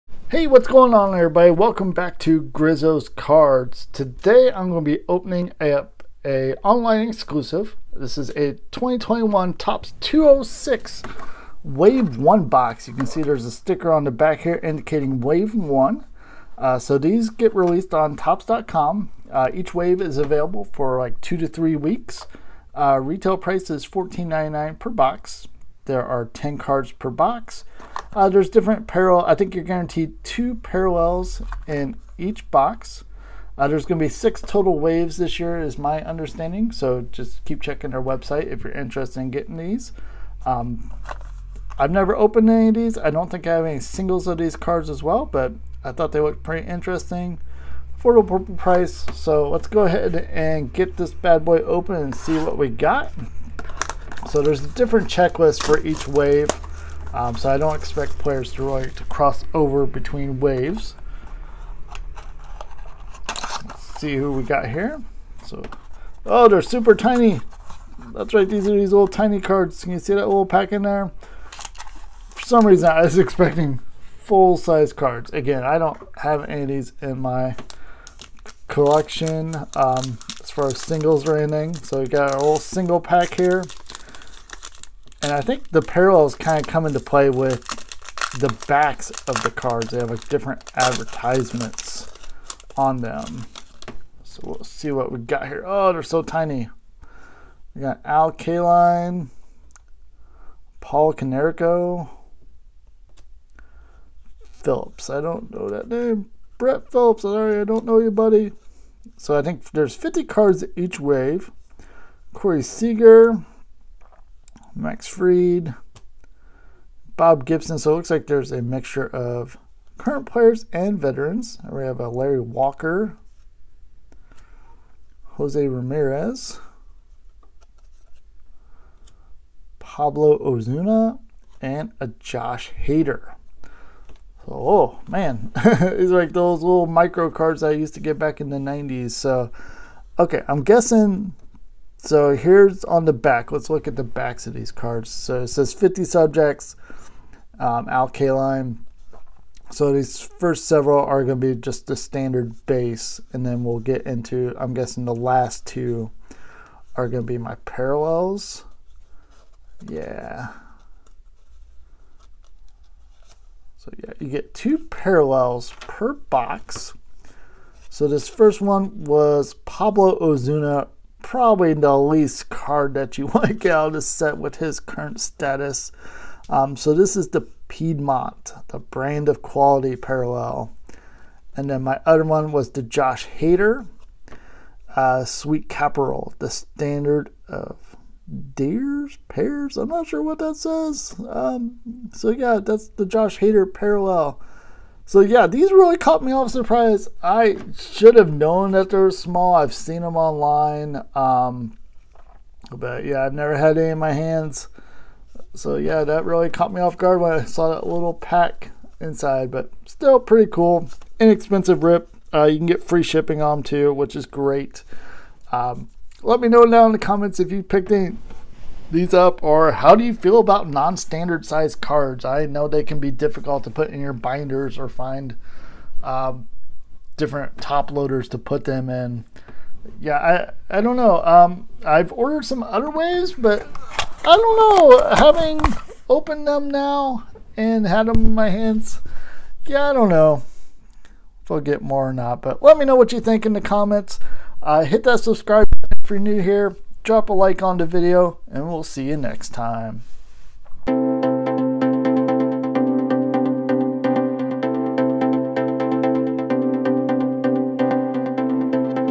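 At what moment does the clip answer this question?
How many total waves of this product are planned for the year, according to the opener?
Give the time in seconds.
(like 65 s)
34 s.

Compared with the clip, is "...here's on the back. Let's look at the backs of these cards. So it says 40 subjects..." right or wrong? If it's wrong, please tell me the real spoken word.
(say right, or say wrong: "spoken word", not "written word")
wrong: "50", not "40".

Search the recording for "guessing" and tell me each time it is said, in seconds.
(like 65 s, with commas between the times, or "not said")
140 s, 154 s.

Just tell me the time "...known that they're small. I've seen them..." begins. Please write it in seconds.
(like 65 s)
198 s.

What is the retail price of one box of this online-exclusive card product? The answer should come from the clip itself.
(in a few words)
$14.99.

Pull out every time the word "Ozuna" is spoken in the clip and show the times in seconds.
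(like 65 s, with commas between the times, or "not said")
130 s, 170 s.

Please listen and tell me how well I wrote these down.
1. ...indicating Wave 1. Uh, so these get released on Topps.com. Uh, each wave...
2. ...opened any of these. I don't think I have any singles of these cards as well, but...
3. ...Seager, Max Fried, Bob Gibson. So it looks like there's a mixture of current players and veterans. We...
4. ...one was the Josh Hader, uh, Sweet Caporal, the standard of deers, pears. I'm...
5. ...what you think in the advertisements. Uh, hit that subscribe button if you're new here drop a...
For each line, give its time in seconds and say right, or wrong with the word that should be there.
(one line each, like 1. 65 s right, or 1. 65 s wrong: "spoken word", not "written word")
1. 14 s right
2. 42 s right
3. 112 s right
4. 182 s right
5. 242 s wrong: "comments", not "advertisements".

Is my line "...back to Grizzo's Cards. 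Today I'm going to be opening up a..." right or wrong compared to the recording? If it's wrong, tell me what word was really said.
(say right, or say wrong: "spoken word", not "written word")
right.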